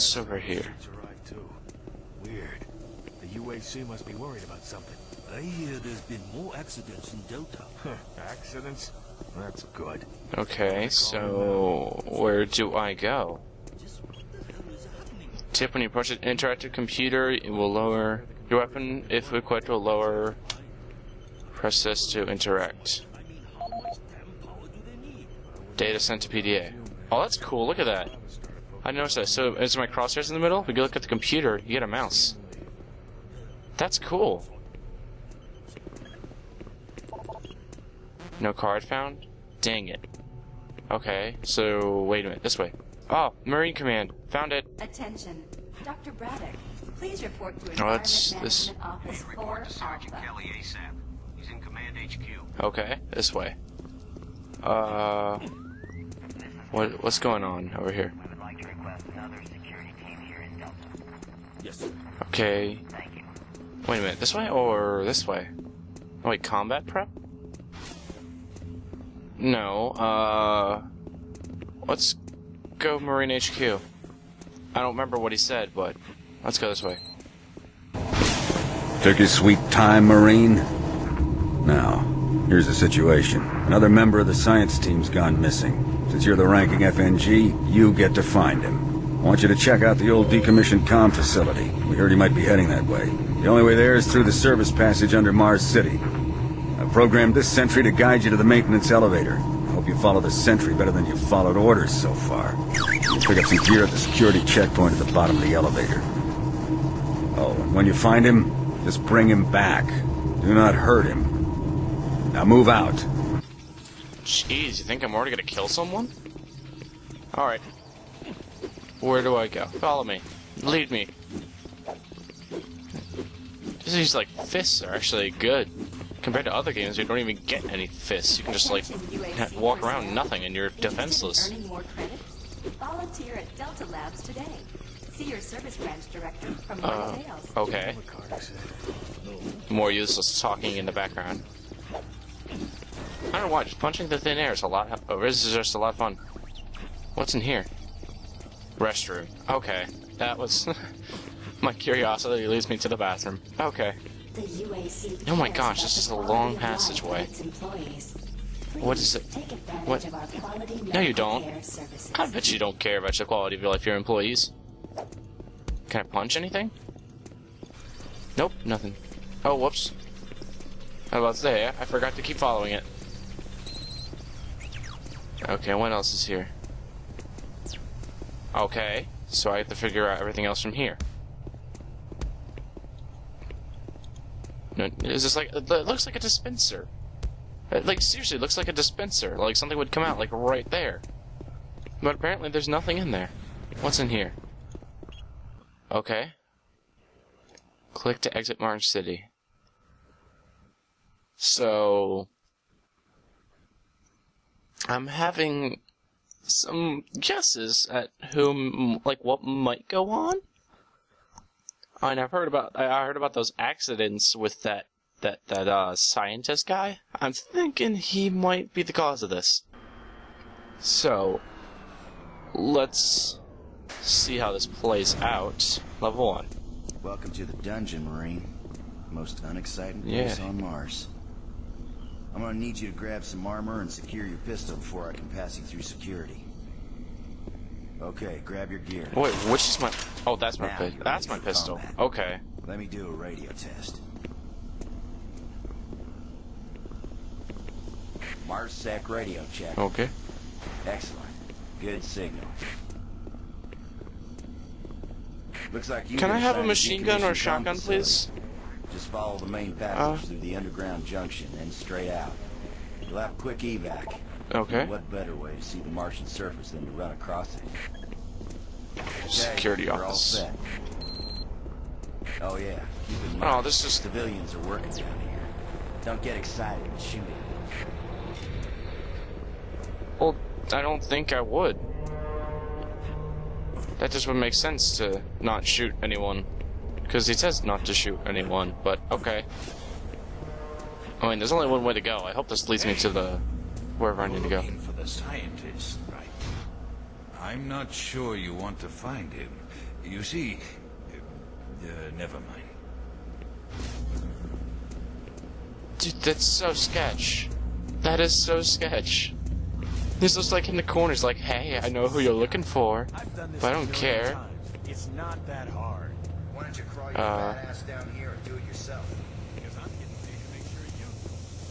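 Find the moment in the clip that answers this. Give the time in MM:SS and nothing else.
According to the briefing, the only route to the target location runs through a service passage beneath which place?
01:35.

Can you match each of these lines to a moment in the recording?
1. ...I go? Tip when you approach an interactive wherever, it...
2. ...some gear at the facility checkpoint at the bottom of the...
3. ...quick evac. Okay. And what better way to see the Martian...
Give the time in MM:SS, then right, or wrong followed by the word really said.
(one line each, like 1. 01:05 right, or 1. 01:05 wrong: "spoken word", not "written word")
1. 00:12 wrong: "computer", not "wherever"
2. 01:43 wrong: "security", not "facility"
3. 04:23 right.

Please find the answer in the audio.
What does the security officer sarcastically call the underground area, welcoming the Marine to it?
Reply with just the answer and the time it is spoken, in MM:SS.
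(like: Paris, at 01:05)
the dungeon, at 03:47.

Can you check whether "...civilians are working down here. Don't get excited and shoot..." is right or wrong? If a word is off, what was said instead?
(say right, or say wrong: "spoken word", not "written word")
right.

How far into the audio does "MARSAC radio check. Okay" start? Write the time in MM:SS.
04:08.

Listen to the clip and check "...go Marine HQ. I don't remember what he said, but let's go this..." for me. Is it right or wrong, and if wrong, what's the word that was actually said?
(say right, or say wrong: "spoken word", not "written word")
right.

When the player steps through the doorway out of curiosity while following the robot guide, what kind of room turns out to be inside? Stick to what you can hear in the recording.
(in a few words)
Restroom.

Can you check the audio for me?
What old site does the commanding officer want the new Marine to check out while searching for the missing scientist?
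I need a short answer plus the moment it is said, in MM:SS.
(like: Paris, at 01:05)
decommissioned com facility, at 01:30.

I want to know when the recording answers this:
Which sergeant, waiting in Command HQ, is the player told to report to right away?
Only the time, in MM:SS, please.
00:50.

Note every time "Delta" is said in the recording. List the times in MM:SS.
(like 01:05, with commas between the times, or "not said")
00:07, 02:13.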